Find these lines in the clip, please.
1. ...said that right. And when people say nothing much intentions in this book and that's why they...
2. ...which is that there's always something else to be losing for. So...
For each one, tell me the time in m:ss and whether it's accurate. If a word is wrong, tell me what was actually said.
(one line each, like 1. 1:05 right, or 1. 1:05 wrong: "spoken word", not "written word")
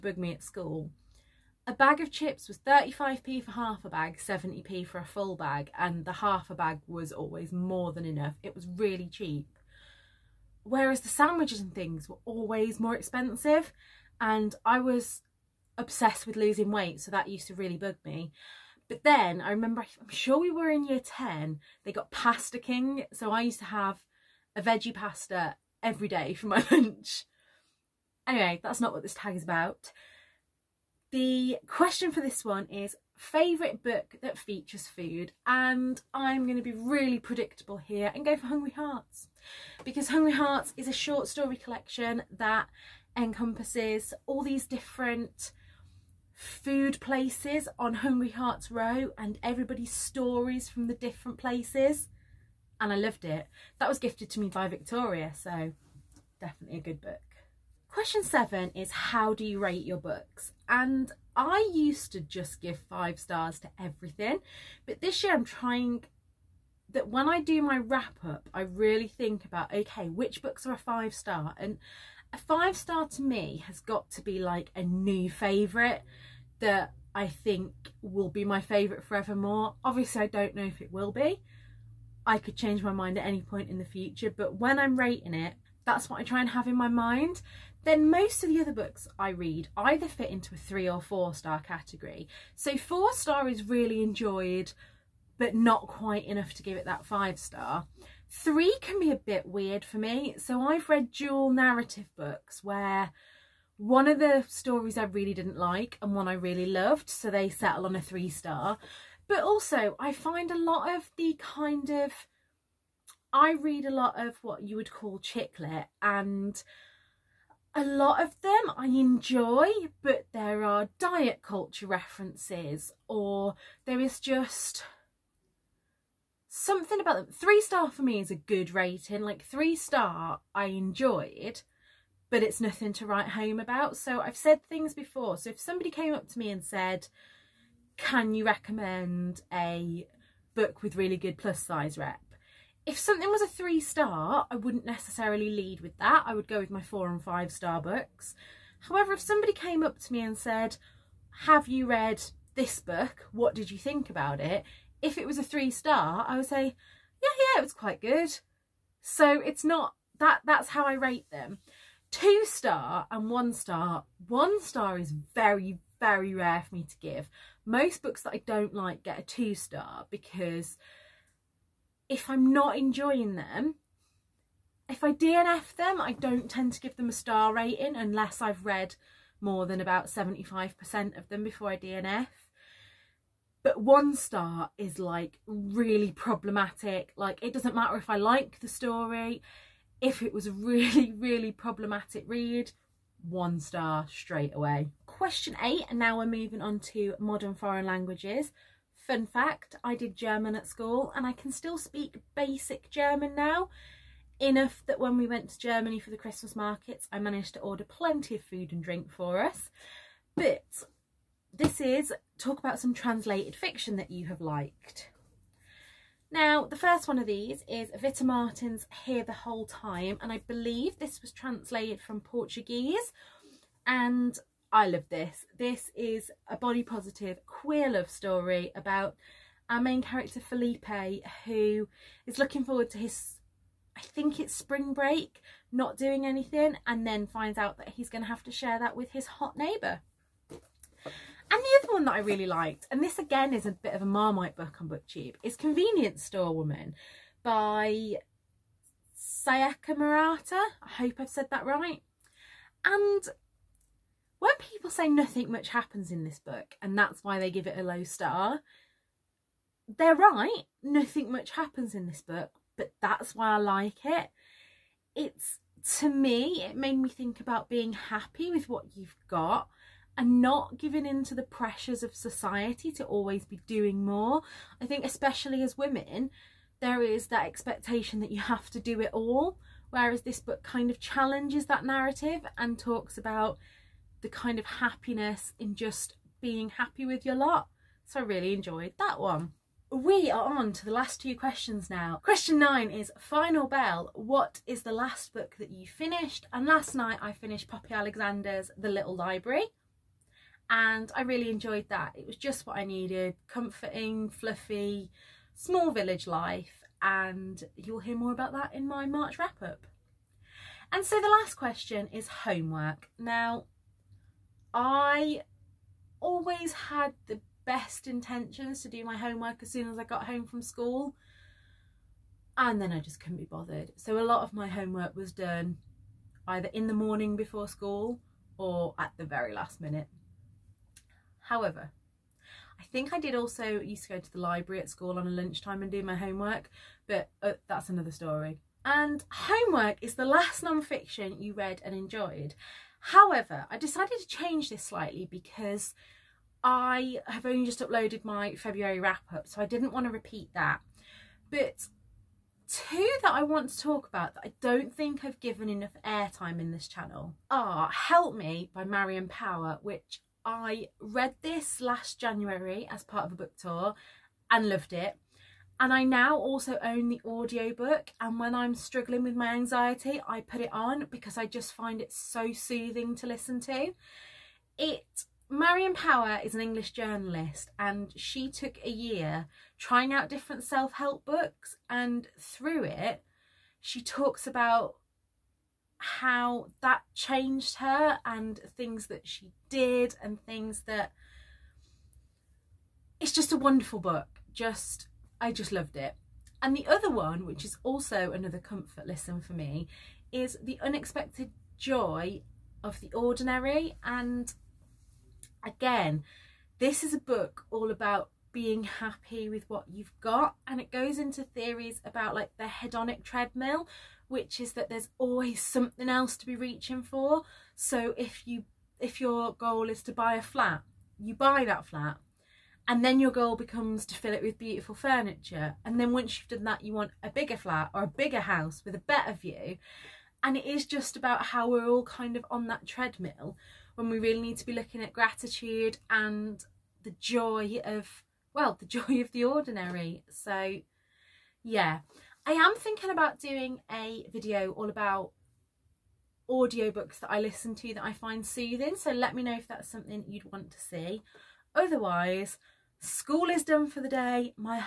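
1. 4:11 wrong: "happens", not "intentions"
2. 6:54 wrong: "reaching", not "losing".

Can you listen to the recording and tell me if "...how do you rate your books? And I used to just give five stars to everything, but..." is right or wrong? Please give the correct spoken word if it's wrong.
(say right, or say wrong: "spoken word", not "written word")
right.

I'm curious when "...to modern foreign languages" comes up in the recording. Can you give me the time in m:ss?
3:16.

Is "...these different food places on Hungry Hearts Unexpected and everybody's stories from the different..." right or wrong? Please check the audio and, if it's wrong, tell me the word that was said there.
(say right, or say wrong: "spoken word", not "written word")
wrong: "Row", not "Unexpected".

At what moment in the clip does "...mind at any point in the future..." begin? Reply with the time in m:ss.
1:22.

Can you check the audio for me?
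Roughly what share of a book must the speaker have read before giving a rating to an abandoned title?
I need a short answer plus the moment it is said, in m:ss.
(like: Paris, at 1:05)
75%, at 3:00.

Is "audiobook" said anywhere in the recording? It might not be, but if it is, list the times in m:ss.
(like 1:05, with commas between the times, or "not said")
6:07, 7:26.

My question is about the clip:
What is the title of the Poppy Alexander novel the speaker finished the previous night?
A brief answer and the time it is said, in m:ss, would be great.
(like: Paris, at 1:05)
The Little Library, at 4:58.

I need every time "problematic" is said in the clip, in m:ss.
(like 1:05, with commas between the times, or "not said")
3:06, 3:11.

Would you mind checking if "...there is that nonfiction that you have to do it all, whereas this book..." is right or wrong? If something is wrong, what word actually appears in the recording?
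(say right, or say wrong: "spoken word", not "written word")
wrong: "expectation", not "nonfiction".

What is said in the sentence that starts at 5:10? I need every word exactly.
And so the last question is homework.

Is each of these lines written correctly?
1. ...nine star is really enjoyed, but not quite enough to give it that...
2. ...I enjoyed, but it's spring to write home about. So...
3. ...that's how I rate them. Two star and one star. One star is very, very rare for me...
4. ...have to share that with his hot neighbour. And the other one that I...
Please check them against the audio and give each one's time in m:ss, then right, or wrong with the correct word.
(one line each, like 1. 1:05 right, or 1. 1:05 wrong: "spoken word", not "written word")
1. 1:32 wrong: "four", not "nine"
2. 2:10 wrong: "nothing", not "spring"
3. 2:40 right
4. 3:58 right.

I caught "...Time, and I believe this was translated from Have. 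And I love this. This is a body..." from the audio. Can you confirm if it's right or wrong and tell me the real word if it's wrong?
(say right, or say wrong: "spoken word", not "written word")
wrong: "Portuguese", not "Have".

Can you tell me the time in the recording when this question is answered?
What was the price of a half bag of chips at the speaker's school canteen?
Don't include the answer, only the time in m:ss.
0:02.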